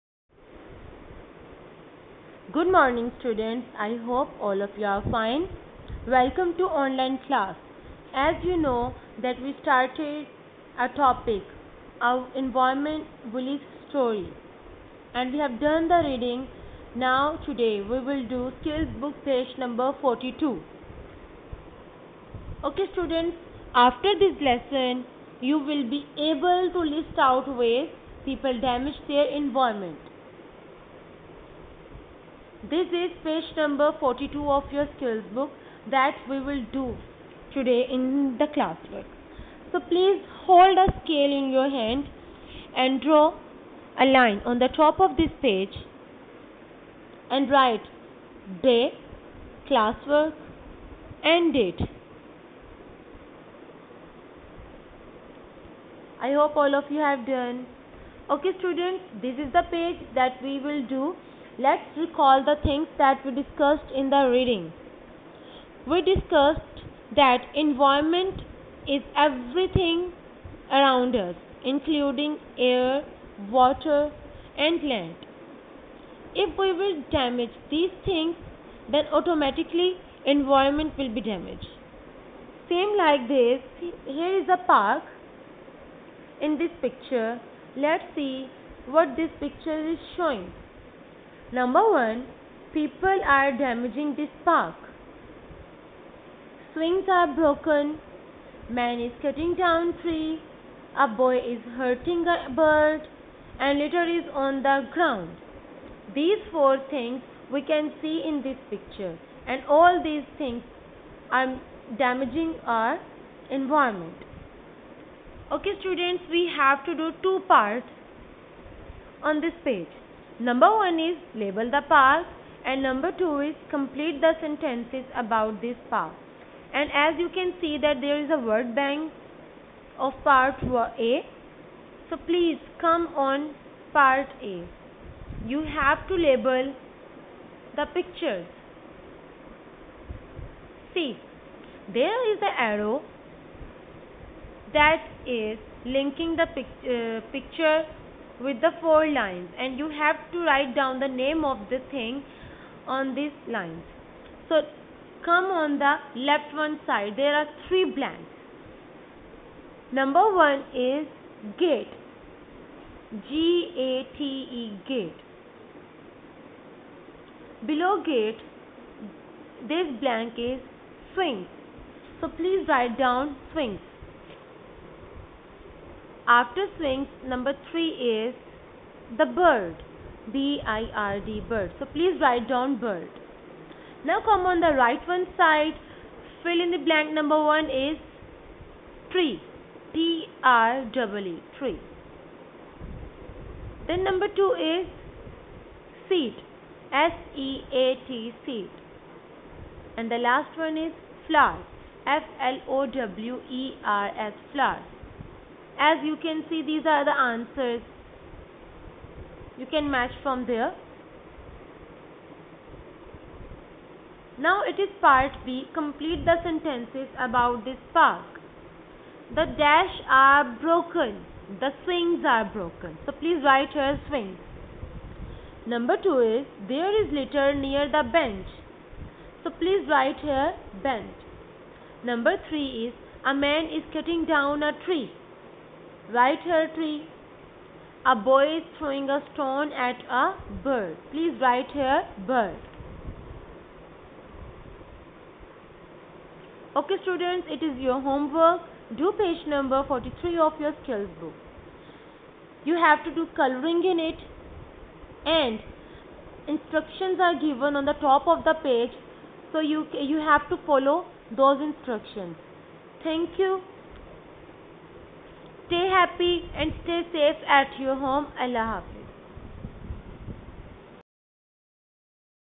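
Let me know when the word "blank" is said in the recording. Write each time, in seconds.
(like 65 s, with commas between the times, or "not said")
157 s, 169 s, 186 s.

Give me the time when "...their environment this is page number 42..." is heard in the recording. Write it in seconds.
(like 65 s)
29 s.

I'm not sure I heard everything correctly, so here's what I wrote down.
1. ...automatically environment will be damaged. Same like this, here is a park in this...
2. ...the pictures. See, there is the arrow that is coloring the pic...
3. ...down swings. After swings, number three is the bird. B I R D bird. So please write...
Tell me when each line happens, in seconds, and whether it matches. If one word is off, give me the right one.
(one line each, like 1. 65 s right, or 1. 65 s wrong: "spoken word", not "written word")
1. 79 s right
2. 137 s wrong: "linking", not "coloring"
3. 172 s right.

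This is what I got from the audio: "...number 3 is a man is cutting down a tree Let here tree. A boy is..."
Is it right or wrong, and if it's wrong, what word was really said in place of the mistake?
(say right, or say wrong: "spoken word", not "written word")
wrong: "Write", not "Let".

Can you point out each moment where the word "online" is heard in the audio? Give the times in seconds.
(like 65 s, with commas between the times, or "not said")
6 s.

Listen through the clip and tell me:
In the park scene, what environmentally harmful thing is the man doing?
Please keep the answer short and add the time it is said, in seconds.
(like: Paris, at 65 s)
cutting down tree, at 99 s.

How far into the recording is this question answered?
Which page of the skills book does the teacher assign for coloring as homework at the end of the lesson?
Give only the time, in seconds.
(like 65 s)
249 s.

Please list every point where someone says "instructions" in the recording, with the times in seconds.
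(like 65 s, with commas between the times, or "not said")
256 s, 261 s.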